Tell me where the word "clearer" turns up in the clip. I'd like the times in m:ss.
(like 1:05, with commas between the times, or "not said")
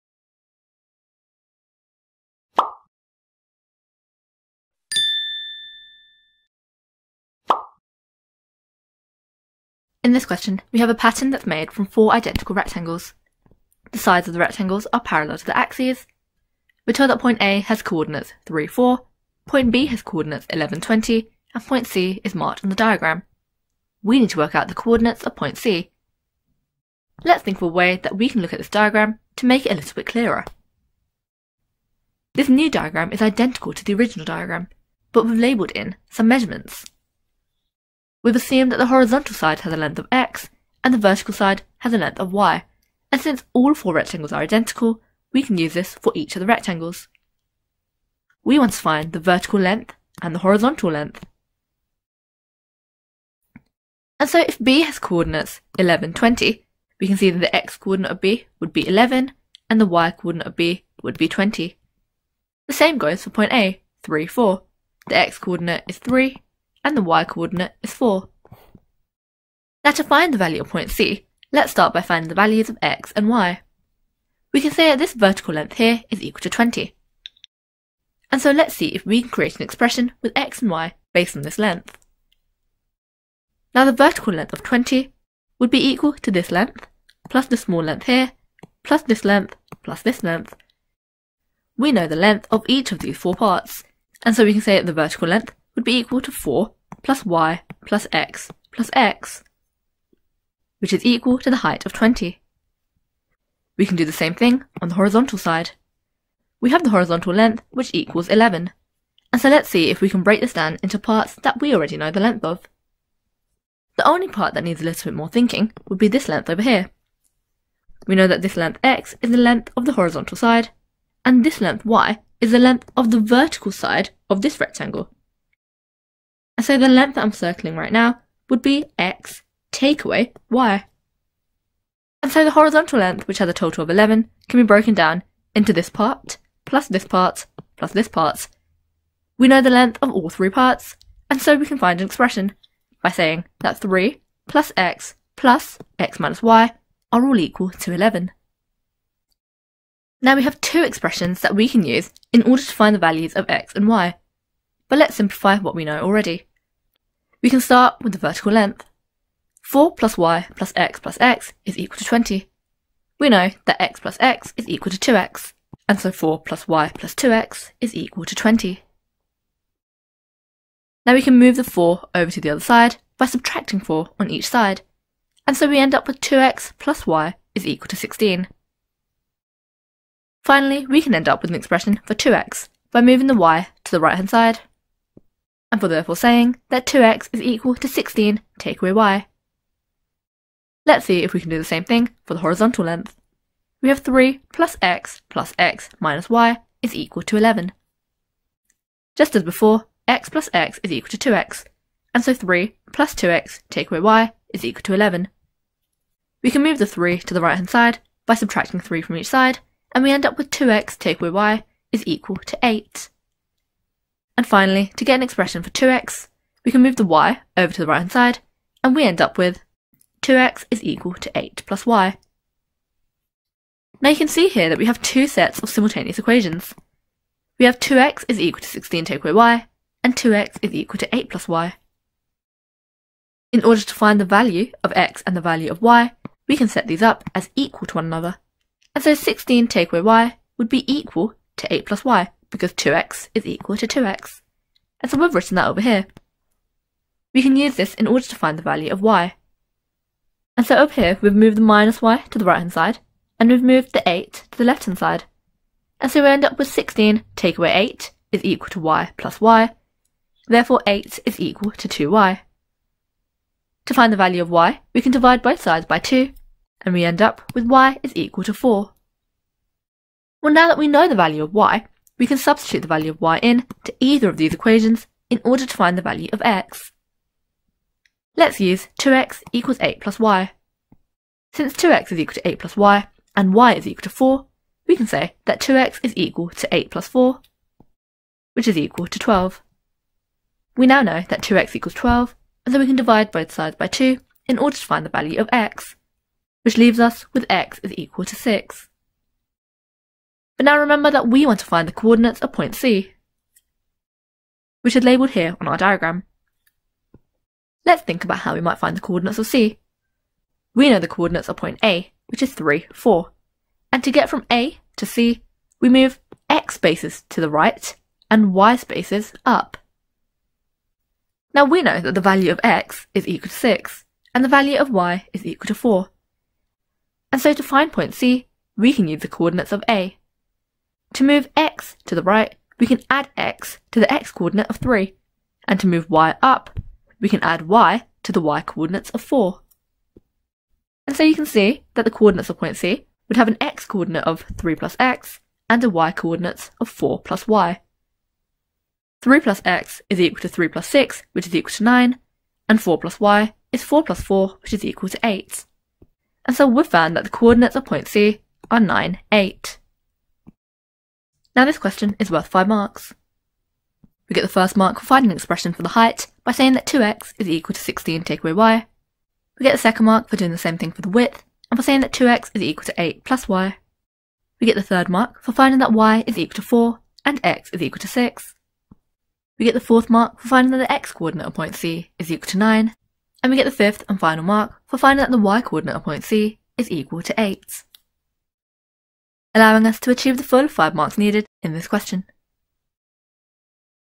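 0:30.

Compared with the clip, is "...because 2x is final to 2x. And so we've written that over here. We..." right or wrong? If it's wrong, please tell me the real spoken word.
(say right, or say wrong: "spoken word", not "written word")
wrong: "equal", not "final".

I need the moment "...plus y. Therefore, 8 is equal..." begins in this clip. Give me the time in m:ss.
4:19.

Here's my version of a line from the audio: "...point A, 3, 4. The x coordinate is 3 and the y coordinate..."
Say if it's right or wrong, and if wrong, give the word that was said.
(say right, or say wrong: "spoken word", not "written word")
right.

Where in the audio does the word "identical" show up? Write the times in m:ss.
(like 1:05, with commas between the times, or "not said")
0:12, 0:33, 0:44.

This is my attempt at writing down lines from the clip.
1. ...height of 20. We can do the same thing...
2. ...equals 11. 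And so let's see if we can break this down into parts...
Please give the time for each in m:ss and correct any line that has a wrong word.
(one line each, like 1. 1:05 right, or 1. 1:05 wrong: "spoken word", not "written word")
1. 1:41 right
2. 1:47 right.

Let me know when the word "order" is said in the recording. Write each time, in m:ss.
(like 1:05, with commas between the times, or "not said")
2:32, 3:53, 4:08, 4:35, 4:54.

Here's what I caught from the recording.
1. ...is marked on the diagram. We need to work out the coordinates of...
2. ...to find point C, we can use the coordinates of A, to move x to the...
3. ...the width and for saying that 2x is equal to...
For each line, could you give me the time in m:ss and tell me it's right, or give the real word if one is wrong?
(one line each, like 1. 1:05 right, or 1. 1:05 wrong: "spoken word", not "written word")
1. 0:22 right
2. 5:27 right
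3. 6:11 right.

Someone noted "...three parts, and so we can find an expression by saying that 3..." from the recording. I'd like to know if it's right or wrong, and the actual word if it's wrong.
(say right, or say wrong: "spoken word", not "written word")
right.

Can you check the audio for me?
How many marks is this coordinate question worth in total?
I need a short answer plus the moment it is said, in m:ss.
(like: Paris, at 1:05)
5, at 6:02.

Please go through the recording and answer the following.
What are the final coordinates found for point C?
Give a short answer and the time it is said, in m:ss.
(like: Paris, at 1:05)
9, 8, at 5:58.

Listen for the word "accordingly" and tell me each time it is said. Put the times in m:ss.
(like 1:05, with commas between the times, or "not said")
not said.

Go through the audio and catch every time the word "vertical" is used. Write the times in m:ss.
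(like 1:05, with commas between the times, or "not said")
0:40, 0:49, 1:15, 1:23, 1:34, 2:03, 2:38.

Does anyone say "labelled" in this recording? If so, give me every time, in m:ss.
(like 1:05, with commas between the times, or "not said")
0:35, 5:05.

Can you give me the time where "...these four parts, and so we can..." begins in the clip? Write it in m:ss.
1:32.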